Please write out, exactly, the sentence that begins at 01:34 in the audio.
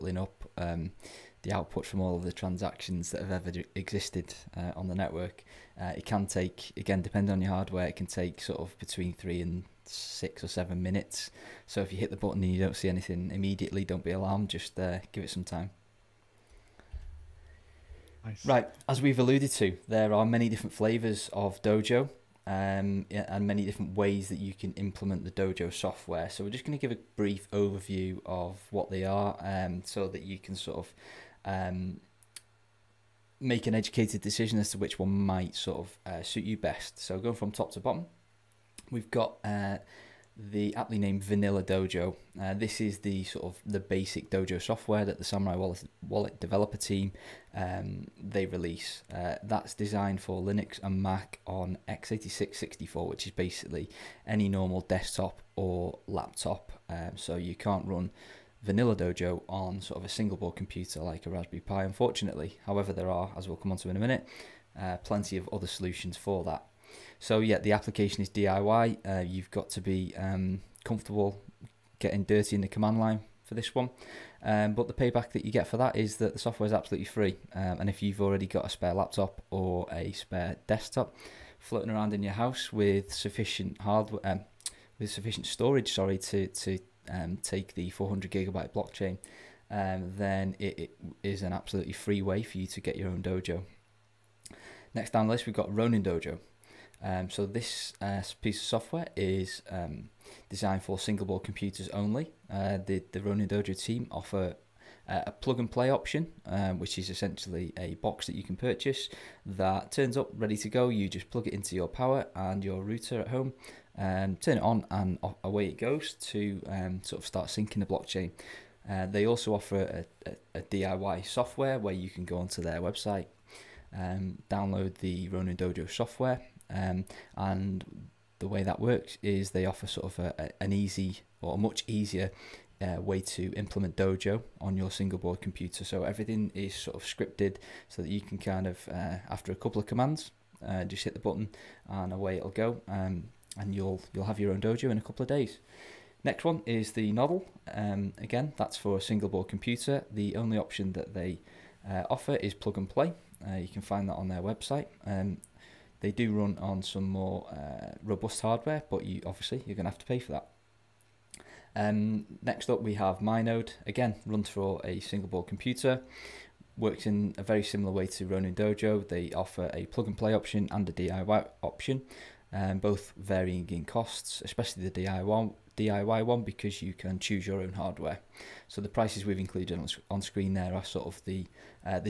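Next down the list, we've got Ronin Dojo.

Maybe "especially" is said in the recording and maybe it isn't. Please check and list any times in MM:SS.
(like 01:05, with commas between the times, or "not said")
02:54.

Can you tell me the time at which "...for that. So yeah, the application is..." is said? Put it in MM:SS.
01:06.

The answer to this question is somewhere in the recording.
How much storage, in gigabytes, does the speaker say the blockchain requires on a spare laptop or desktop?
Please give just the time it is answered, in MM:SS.
01:27.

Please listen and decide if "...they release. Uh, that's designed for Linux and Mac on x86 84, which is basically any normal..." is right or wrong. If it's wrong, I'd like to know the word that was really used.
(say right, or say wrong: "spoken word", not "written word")
wrong: "64", not "84".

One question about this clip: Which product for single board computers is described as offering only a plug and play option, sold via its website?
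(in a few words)
Nodl.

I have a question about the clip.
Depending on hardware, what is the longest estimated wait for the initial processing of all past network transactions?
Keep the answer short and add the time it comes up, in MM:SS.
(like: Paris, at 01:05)
7 minutes, at 00:10.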